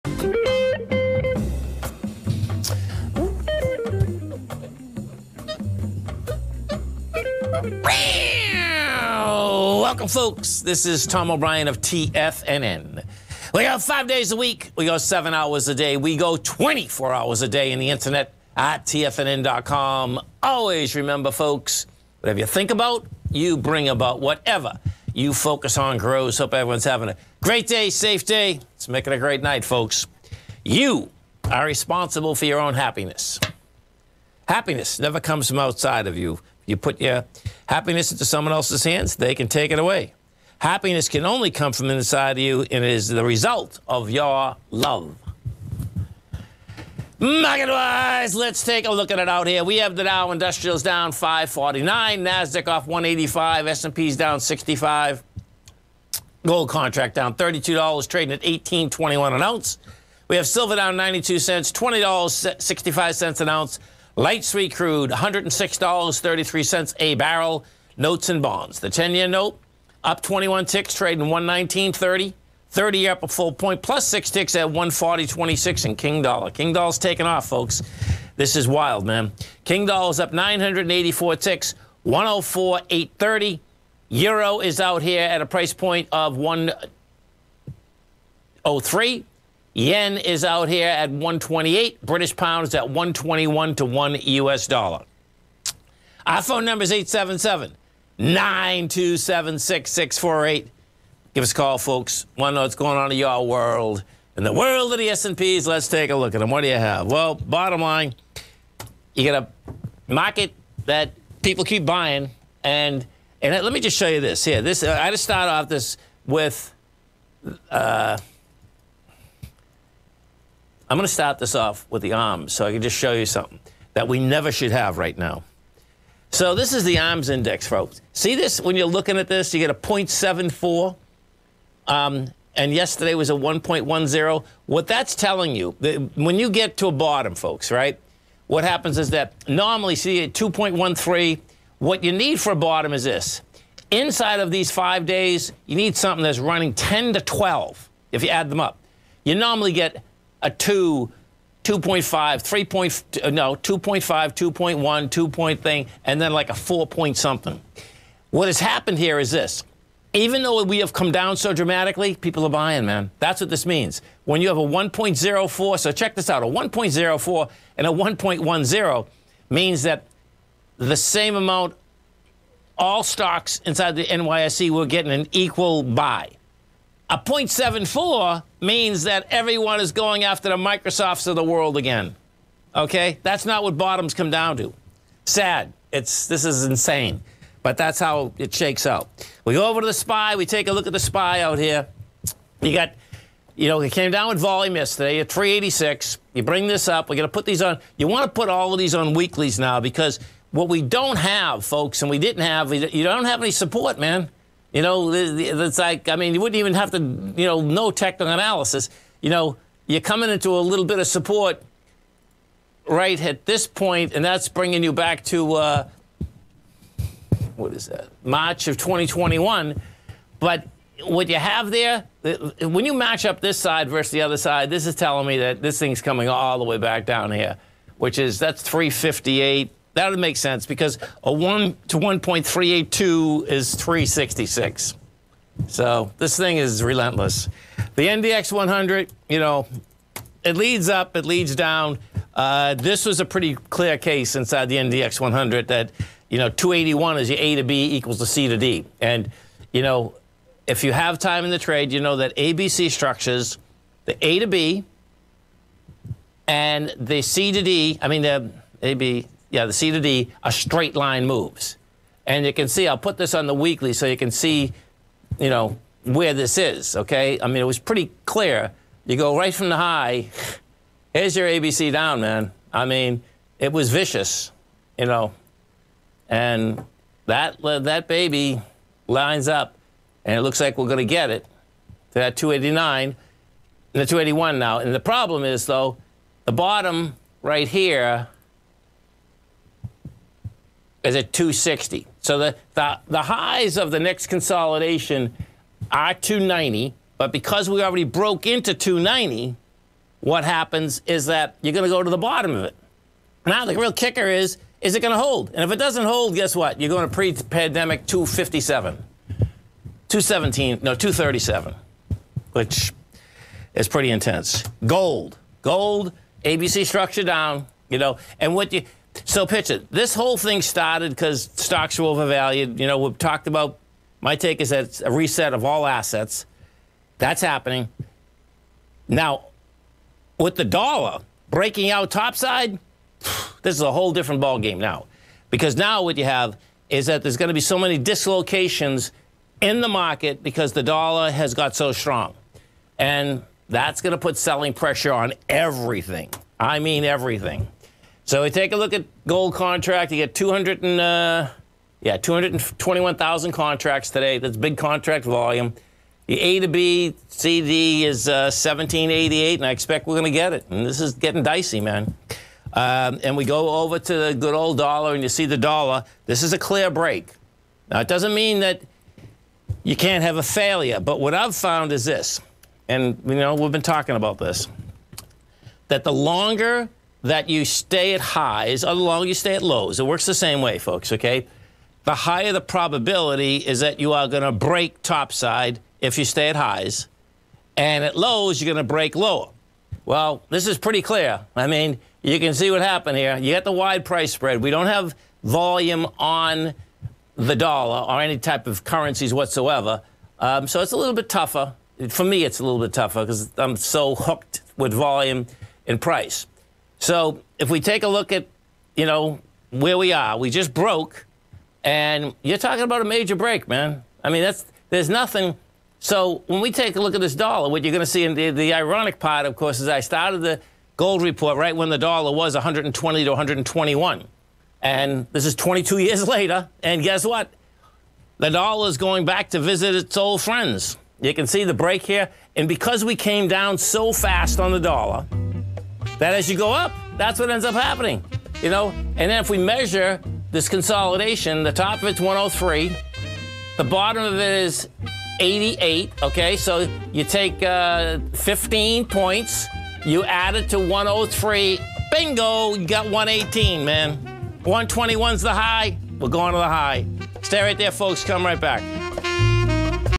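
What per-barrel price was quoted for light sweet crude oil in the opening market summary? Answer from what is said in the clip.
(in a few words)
$106.33.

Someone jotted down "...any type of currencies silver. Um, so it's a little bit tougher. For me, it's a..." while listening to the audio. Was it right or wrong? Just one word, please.
wrong.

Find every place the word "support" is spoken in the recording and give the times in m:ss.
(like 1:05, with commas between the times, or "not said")
3:23, 3:31.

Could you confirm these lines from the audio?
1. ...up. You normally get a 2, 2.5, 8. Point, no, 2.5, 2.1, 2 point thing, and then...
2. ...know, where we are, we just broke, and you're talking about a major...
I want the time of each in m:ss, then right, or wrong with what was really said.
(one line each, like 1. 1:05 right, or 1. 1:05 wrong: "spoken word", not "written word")
1. 2:28 wrong: "3", not "8"
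2. 6:49 right.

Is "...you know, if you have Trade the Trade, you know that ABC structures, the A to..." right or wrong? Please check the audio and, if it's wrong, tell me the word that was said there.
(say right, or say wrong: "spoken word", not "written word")
wrong: "Timing", not "Trade".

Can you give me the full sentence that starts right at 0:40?
Happiness can only come from inside you, and it is the result of your love.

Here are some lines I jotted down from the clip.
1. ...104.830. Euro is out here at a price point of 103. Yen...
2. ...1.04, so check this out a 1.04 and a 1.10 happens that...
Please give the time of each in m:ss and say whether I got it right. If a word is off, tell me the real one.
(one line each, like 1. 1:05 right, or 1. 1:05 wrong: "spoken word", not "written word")
1. 1:22 right
2. 2:44 wrong: "means", not "happens".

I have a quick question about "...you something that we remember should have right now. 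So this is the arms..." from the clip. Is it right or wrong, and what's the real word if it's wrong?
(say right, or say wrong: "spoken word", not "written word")
wrong: "never", not "remember".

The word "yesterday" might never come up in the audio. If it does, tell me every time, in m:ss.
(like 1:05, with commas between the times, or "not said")
2:12, 3:14.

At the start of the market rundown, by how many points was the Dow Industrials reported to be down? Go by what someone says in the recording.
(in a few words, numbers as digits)
549.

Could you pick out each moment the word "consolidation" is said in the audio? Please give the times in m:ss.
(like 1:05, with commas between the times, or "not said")
4:54, 7:20.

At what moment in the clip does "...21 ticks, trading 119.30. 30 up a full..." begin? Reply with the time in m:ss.
1:10.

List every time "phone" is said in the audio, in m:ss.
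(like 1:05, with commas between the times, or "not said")
1:36.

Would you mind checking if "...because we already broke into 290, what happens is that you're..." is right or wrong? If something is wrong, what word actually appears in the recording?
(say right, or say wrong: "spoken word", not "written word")
right.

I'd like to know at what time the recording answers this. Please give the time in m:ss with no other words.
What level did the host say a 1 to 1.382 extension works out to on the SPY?
3:53.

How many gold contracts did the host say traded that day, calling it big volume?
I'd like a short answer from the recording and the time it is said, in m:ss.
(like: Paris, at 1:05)
221,000, at 5:52.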